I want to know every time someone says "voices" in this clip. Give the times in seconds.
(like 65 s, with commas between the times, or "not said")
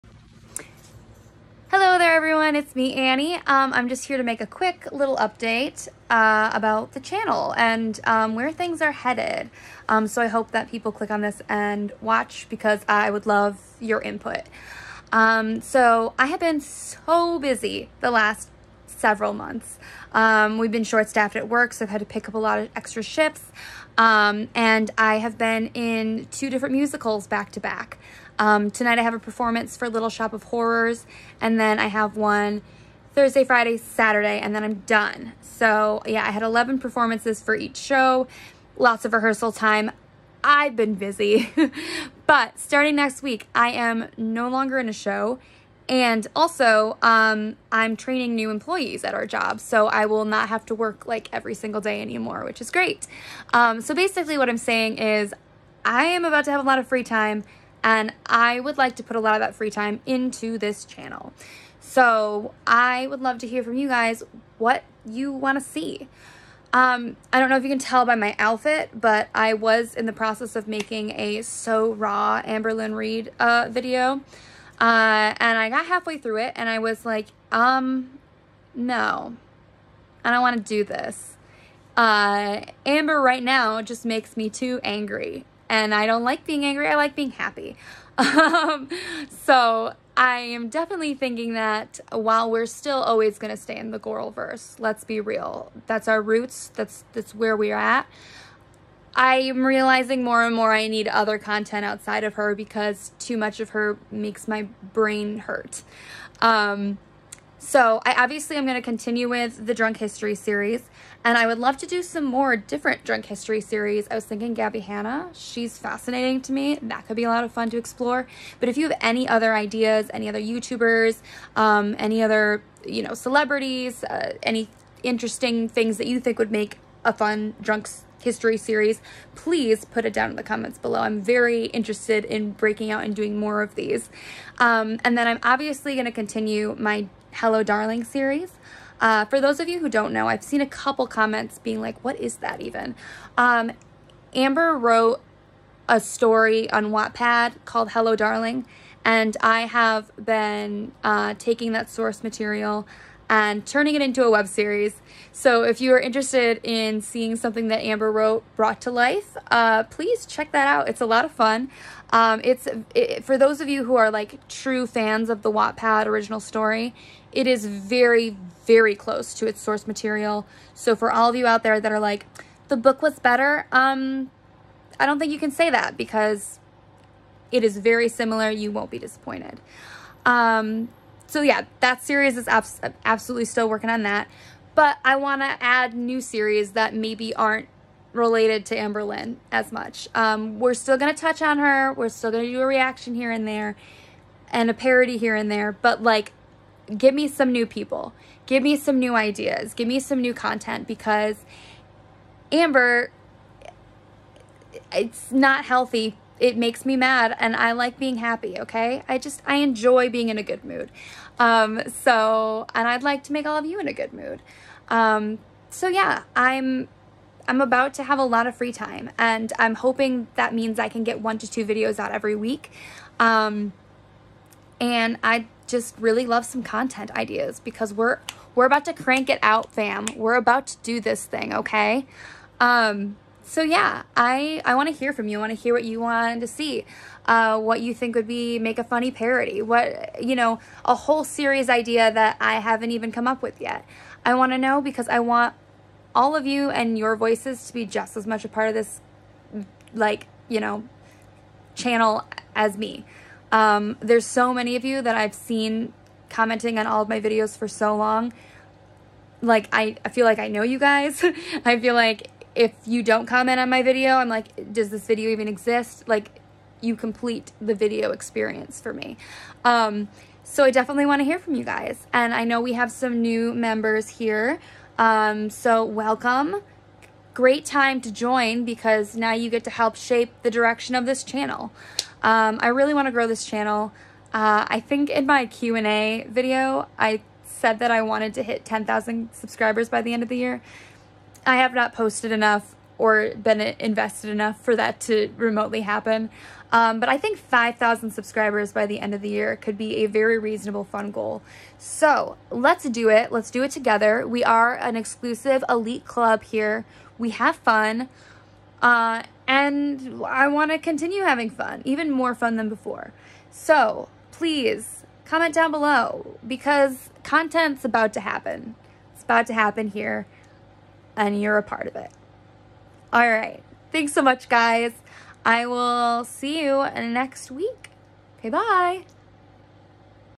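247 s.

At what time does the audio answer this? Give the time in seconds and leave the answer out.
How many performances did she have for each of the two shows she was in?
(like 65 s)
36 s.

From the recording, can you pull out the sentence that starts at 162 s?
Um, it's it, for those of you who are like true fans of the Wattpad original story.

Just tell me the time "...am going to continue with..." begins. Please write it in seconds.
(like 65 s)
108 s.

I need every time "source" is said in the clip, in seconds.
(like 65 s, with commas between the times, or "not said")
151 s, 169 s.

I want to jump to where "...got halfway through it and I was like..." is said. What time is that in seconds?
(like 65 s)
75 s.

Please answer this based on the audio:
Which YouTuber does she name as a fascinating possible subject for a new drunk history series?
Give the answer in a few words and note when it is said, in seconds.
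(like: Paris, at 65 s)
Gabby Hanna, at 114 s.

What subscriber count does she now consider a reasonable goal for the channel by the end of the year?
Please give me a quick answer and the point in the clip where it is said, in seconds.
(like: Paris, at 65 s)
5,000, at 297 s.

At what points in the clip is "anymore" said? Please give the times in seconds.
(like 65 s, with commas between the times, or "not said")
52 s.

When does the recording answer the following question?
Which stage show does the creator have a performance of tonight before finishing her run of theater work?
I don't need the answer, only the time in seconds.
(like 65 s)
29 s.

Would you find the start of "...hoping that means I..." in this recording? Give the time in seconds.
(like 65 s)
219 s.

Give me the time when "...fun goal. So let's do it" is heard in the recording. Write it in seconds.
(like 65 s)
300 s.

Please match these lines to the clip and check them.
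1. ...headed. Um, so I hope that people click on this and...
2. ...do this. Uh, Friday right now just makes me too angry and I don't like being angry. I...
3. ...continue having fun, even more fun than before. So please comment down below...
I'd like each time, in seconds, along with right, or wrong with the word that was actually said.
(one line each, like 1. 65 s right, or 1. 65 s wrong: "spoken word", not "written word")
1. 8 s right
2. 80 s wrong: "Amber", not "Friday"
3. 310 s right.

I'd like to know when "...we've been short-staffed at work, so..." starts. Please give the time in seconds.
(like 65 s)
20 s.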